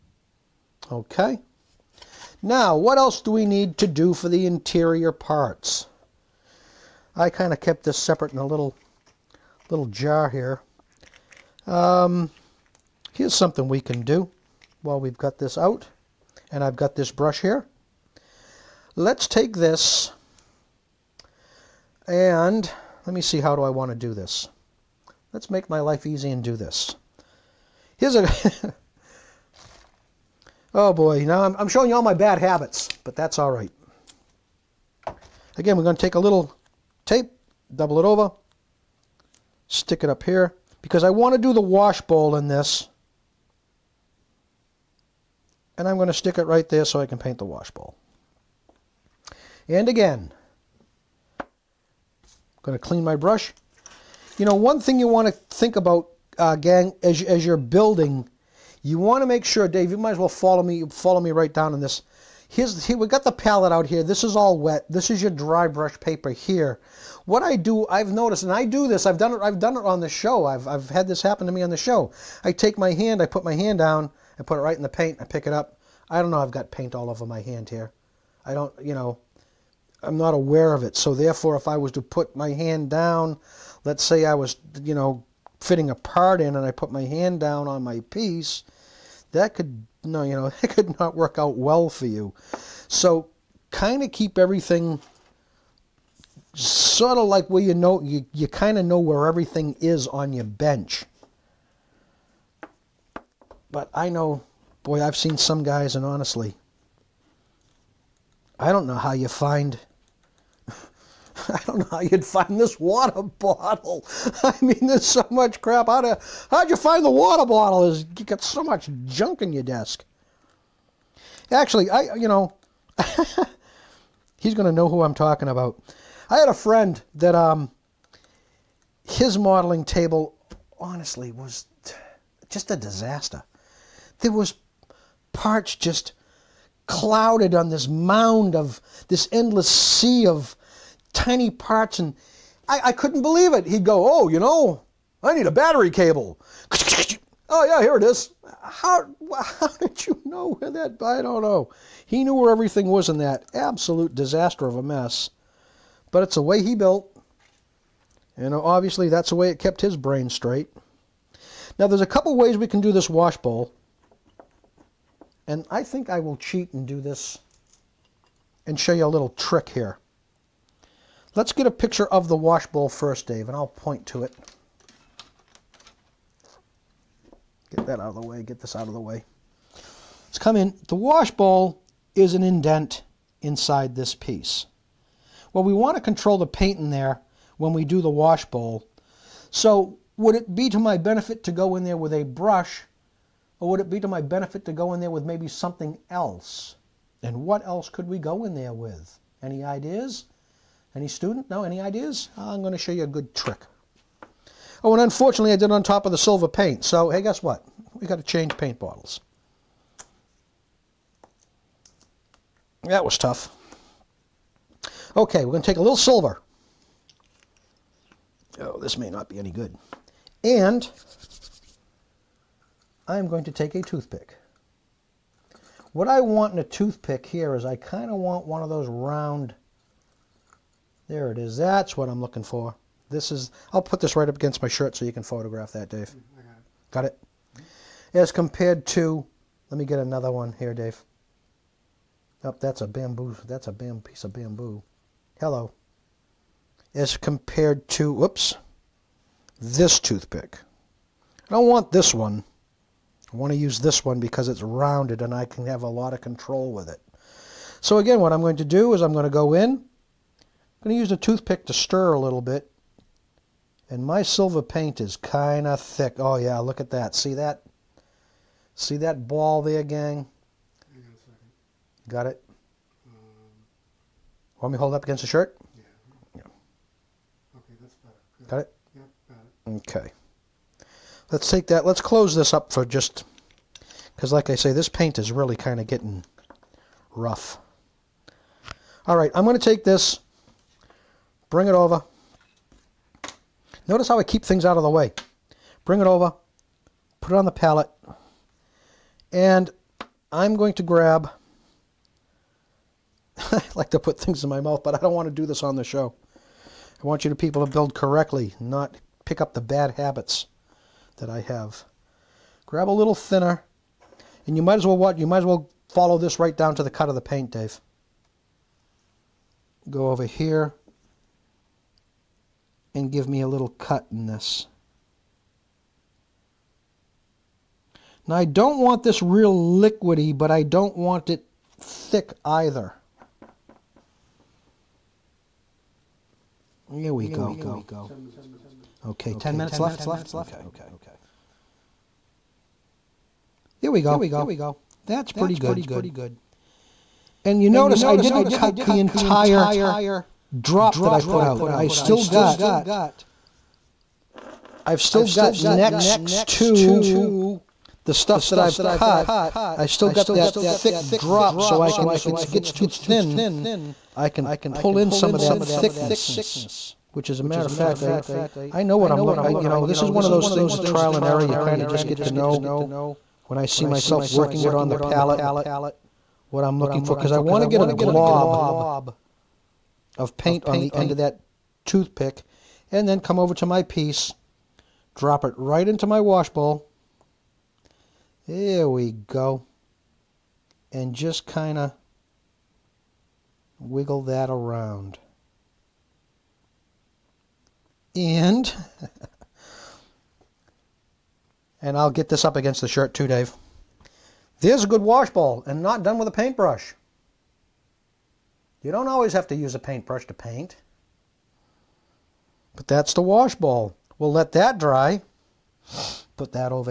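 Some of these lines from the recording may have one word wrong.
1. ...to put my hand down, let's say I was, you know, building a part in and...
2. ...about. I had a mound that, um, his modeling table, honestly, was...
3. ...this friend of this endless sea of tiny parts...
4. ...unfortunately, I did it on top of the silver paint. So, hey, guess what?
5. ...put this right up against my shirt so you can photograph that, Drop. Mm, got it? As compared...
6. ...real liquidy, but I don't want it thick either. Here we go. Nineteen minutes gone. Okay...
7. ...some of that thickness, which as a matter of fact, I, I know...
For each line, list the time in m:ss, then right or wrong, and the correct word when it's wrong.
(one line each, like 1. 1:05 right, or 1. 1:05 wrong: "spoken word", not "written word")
1. 1:21 wrong: "fitting", not "building"
2. 2:05 wrong: "friend", not "mound"
3. 2:17 wrong: "mound", not "friend"
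4. 3:25 right
5. 3:53 wrong: "Dave", not "Drop"
6. 5:29 wrong: "Ten", not "Nineteen"
7. 6:05 right.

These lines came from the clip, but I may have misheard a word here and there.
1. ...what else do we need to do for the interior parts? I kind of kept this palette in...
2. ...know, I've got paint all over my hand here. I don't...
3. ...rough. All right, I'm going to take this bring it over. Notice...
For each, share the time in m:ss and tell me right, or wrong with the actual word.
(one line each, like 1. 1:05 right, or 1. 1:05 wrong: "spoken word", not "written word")
1. 0:02 wrong: "separate", not "palette"
2. 1:16 right
3. 4:47 right.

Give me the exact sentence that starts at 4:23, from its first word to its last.
And my silver paint is kind of thick.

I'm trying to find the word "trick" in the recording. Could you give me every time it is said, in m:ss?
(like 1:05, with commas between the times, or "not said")
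2:49, 3:23.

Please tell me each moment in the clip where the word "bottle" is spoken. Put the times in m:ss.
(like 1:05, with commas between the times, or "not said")
1:53, 1:57, 3:28.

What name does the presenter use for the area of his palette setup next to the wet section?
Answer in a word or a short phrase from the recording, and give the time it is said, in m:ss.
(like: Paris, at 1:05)
dry brush paper, at 1:05.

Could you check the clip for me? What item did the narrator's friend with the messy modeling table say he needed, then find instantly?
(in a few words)
battery cable.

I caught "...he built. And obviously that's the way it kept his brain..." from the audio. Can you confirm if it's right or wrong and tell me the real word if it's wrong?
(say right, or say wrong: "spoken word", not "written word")
right.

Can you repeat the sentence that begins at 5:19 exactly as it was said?
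Go over here, and give me a little cut in this.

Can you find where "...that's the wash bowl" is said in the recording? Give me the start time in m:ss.
6:52.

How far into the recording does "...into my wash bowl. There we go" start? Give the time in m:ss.
6:25.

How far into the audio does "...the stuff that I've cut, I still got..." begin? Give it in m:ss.
5:58.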